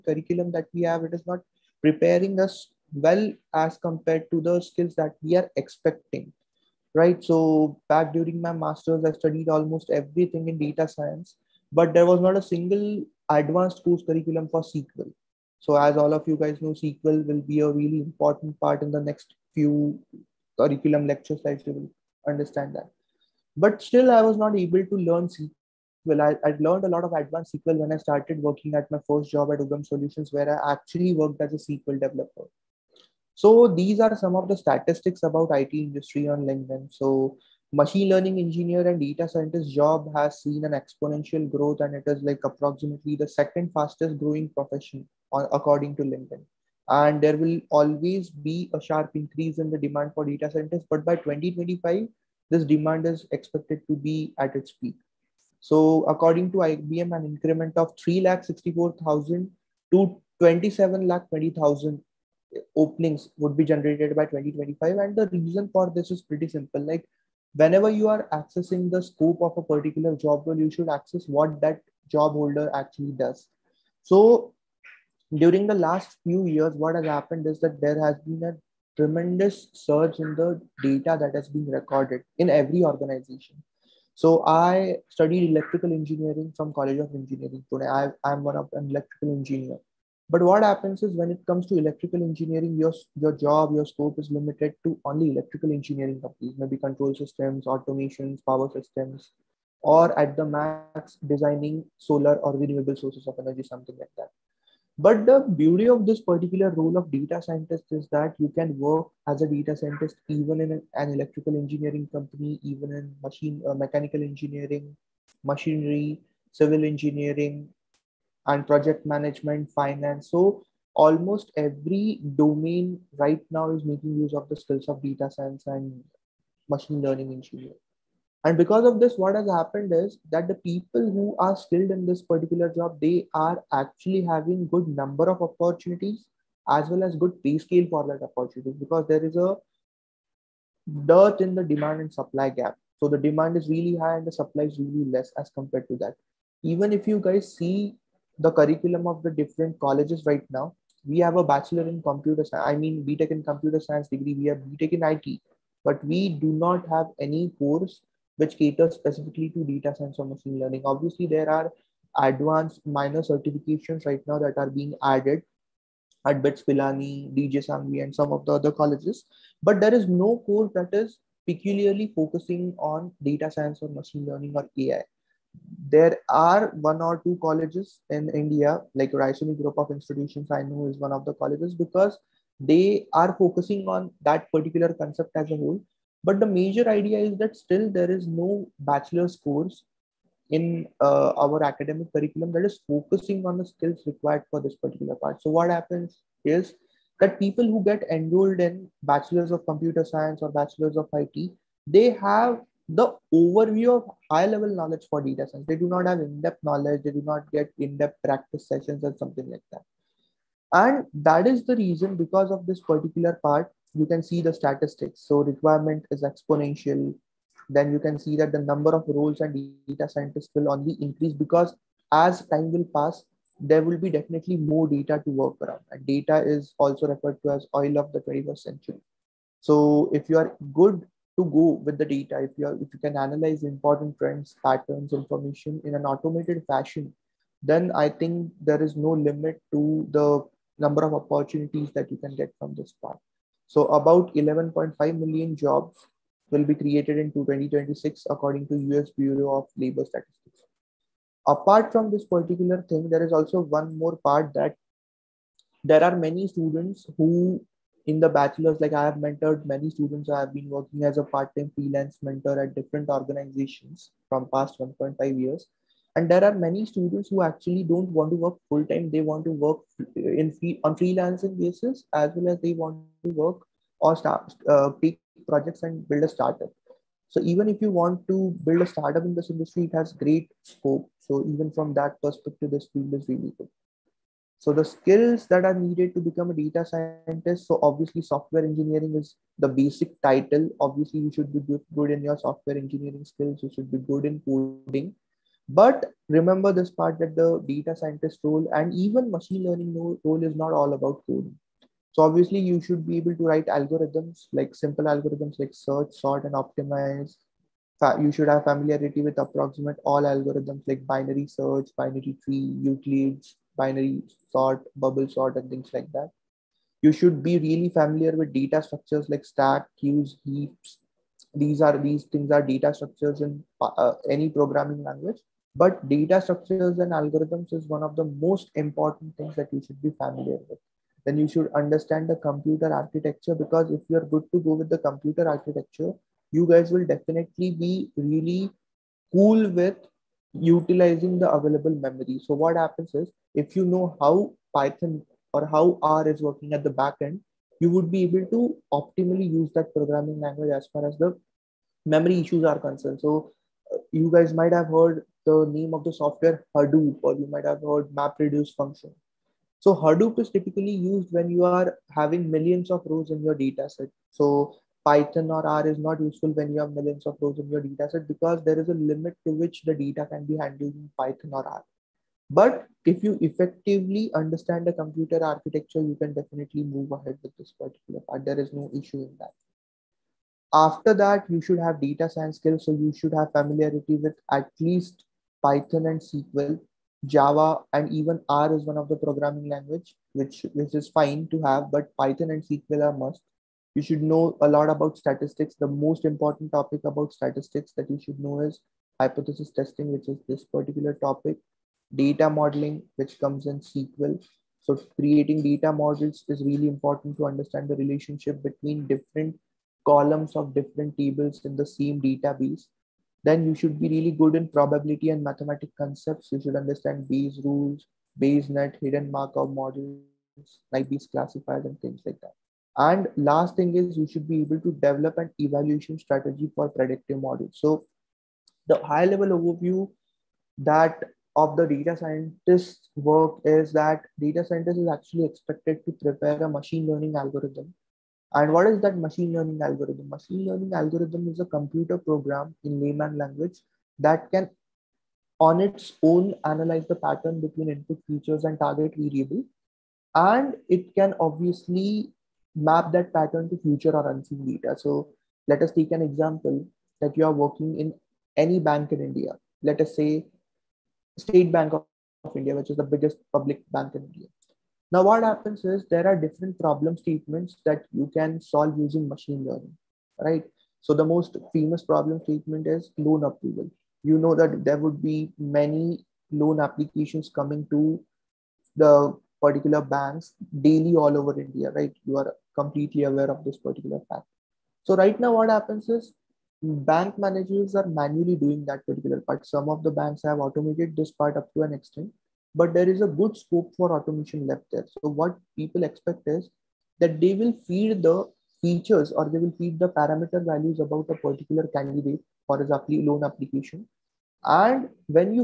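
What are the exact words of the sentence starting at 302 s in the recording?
So obviously you should be able to write algorithms like simple algorithms like search, sort, and optimize.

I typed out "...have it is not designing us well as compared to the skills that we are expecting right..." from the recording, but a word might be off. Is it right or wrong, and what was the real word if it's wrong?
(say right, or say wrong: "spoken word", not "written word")
wrong: "preparing", not "designing".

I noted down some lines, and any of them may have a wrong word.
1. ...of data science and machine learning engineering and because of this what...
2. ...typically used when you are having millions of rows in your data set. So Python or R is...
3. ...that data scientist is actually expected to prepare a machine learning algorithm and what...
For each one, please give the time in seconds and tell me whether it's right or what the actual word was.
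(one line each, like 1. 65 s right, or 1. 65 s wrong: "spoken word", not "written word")
1. 124 s right
2. 360 s right
3. 433 s right.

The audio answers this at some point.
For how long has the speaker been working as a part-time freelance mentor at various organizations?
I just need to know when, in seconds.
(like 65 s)
264 s.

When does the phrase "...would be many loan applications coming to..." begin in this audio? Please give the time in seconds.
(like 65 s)
474 s.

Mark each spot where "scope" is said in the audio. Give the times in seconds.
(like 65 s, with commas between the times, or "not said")
69 s, 93 s, 280 s, 493 s.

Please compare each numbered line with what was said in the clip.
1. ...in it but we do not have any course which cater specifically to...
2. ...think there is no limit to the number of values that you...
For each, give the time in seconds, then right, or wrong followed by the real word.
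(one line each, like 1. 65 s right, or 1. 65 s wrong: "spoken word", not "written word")
1. 154 s right
2. 238 s wrong: "opportunities", not "values".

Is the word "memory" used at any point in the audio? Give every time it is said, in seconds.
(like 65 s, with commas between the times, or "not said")
341 s, 352 s.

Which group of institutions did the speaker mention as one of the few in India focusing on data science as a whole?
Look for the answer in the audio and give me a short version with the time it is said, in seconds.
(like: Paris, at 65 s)
Raisoni Group of Institutions, at 179 s.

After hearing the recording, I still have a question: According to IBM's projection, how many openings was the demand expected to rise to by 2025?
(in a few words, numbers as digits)
27 lakh 20,000.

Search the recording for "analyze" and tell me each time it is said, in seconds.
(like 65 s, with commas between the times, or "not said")
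233 s, 446 s.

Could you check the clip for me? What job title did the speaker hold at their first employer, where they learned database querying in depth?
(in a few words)
SQL developer.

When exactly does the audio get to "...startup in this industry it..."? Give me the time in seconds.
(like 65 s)
278 s.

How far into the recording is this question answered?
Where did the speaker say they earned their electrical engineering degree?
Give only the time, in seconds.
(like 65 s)
86 s.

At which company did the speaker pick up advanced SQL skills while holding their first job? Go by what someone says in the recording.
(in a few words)
Ugam Solutions.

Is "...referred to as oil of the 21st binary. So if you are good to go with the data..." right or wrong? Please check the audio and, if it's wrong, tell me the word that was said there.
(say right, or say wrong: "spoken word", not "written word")
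wrong: "century", not "binary".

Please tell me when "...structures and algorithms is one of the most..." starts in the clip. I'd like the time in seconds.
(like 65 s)
326 s.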